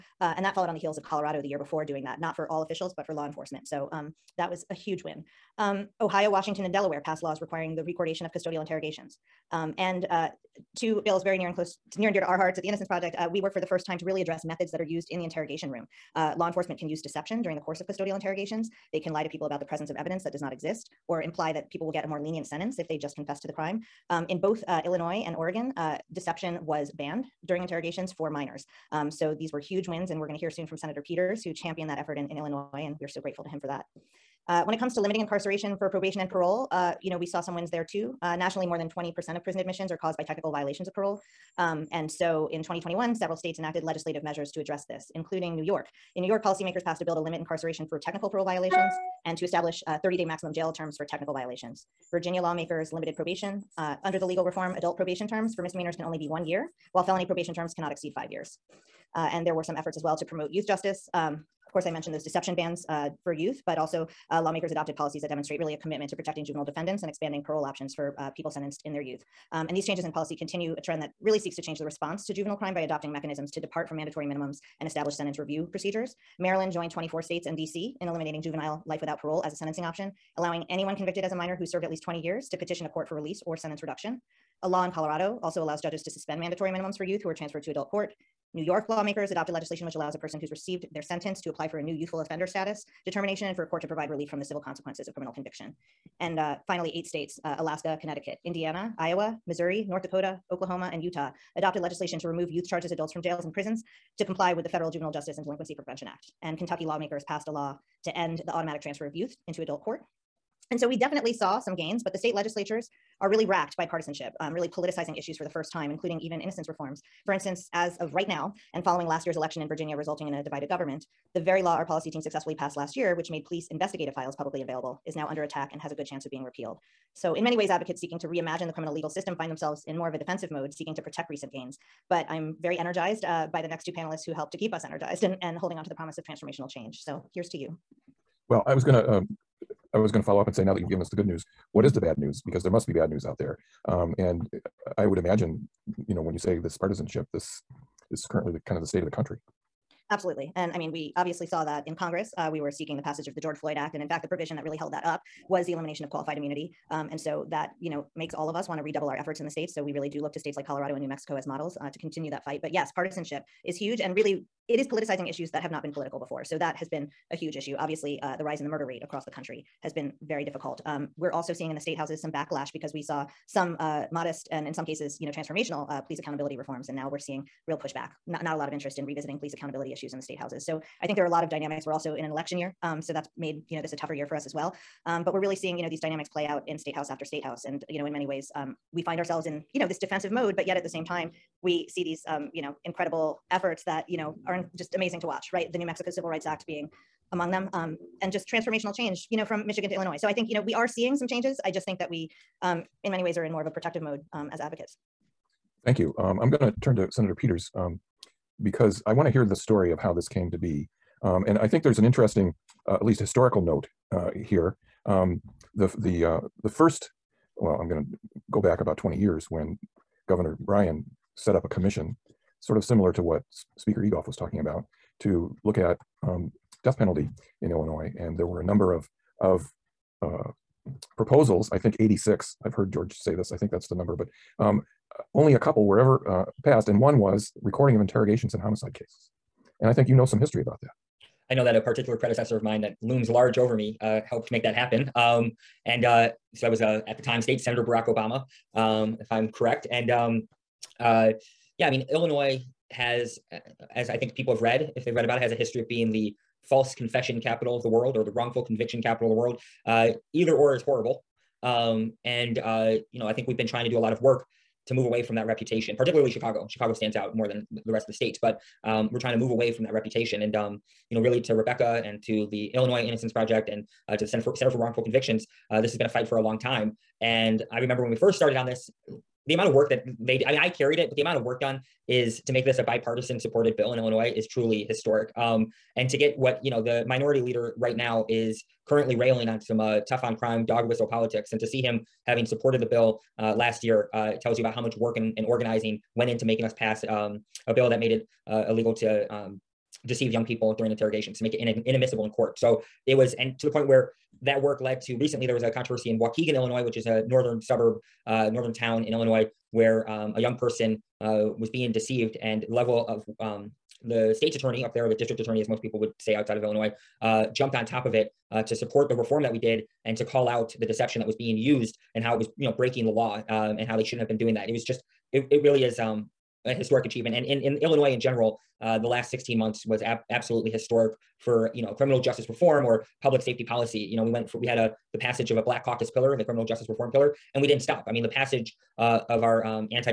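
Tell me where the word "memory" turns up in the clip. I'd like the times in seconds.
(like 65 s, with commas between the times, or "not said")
not said.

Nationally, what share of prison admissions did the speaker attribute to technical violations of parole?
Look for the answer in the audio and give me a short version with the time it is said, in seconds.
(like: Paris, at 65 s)
More than 20%, at 38 s.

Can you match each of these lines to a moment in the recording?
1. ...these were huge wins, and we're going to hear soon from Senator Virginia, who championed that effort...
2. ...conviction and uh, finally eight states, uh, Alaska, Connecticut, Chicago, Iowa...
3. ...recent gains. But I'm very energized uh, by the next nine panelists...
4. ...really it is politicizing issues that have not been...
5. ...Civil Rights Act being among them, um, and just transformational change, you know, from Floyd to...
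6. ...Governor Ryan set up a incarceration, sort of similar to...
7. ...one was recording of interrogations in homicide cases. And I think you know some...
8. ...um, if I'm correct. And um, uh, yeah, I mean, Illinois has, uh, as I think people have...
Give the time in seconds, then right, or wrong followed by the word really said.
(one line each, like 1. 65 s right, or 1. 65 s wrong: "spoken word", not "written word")
1. 29 s wrong: "Peters", not "Virginia"
2. 95 s wrong: "Indiana", not "Chicago"
3. 131 s wrong: "two", not "nine"
4. 164 s right
5. 196 s wrong: "Michigan", not "Floyd"
6. 220 s wrong: "commission", not "incarceration"
7. 236 s right
8. 248 s right.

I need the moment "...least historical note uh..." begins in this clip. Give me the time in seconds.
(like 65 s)
213 s.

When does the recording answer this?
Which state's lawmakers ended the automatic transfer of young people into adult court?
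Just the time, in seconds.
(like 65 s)
106 s.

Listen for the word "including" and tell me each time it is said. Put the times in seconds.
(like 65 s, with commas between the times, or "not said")
45 s, 115 s.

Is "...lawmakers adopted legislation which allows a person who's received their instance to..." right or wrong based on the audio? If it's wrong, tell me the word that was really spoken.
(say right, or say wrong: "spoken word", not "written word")
wrong: "sentence", not "instance".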